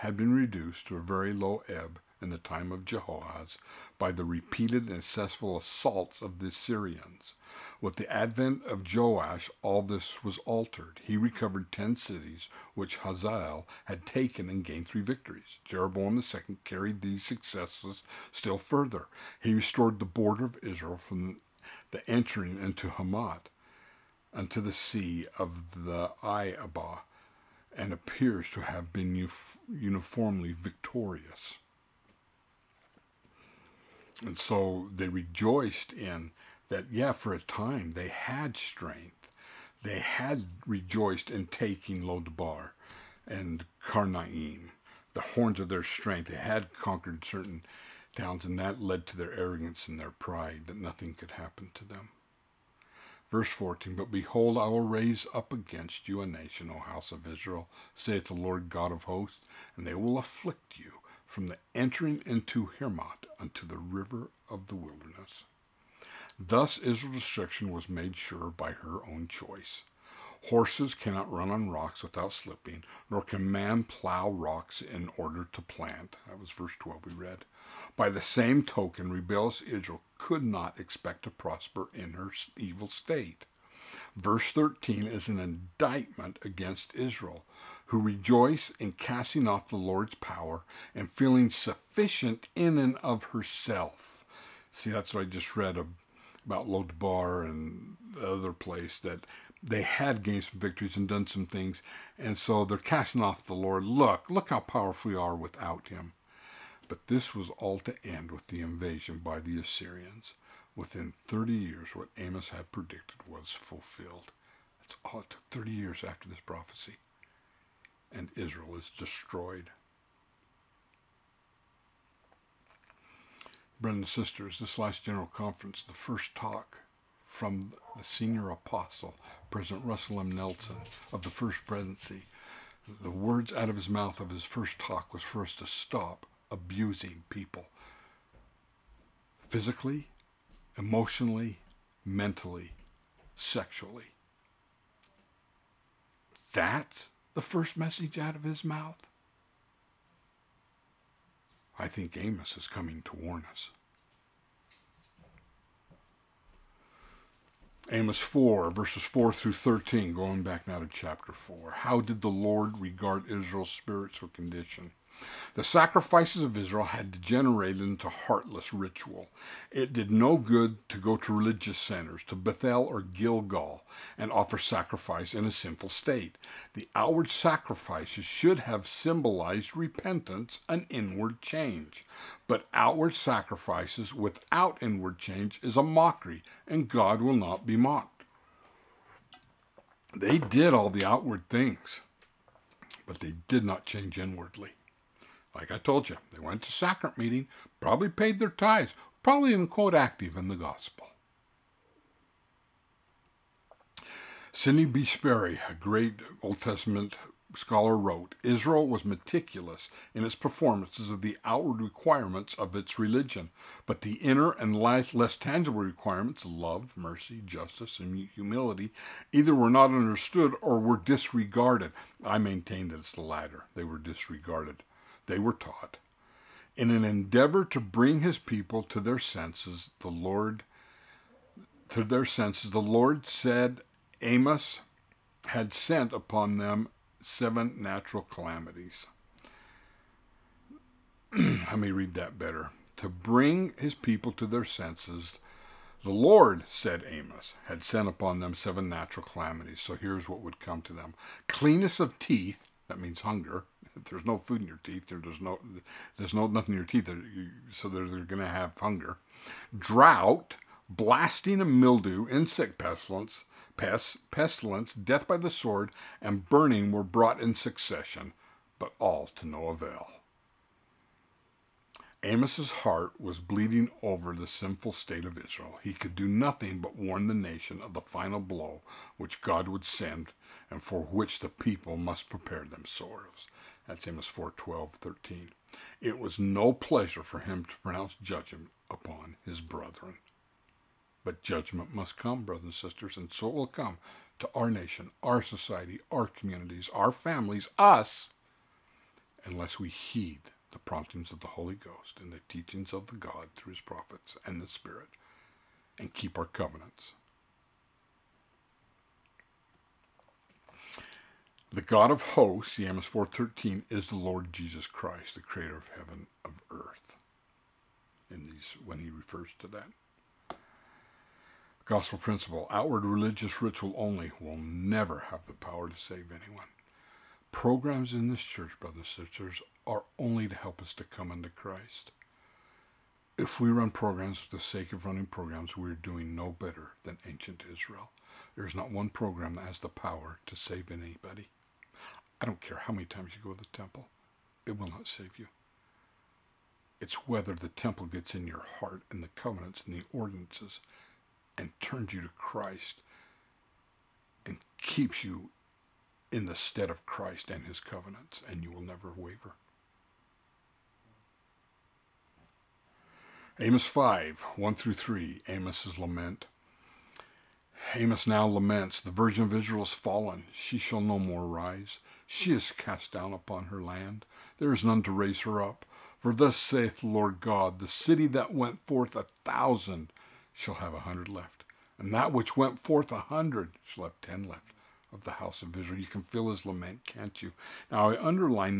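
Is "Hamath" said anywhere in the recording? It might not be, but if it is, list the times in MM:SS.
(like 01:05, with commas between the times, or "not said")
00:22, 01:02.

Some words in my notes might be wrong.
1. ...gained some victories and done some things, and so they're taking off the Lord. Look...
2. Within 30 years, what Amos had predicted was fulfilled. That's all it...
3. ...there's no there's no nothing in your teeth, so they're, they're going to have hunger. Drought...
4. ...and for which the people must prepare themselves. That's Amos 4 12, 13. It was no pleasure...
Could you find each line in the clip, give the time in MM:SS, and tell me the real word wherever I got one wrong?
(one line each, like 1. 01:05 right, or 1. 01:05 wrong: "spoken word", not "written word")
1. 01:40 wrong: "casting", not "taking"
2. 01:50 right
3. 04:15 right
4. 04:40 right.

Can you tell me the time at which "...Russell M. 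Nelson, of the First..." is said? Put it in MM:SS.
02:09.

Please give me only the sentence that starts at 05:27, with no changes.
Programs in this church, brothers and sisters, are only to help us to come unto Christ.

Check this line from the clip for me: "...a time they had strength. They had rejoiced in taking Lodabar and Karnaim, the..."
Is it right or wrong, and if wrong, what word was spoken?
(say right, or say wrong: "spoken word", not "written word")
right.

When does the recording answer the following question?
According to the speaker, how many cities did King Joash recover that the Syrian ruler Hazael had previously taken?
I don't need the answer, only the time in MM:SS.
00:11.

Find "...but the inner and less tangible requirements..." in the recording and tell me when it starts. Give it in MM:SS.
03:33.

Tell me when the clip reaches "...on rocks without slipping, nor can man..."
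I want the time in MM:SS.
01:11.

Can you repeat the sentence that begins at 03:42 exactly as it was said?
I maintain that it's the latter, they were disregarded they were taught.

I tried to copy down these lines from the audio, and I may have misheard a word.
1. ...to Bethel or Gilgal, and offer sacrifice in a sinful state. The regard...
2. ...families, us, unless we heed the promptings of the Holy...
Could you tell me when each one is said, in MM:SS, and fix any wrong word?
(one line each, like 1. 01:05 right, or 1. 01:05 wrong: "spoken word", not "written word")
1. 02:52 wrong: "outward", not "regard"
2. 04:57 right.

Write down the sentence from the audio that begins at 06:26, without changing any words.
You can feel his lament, can't you?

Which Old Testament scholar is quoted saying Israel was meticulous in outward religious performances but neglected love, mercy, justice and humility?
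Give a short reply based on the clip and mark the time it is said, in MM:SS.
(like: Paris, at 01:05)
Sidney B. Sperry, at 03:24.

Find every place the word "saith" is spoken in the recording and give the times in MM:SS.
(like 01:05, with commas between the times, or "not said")
00:57, 06:16.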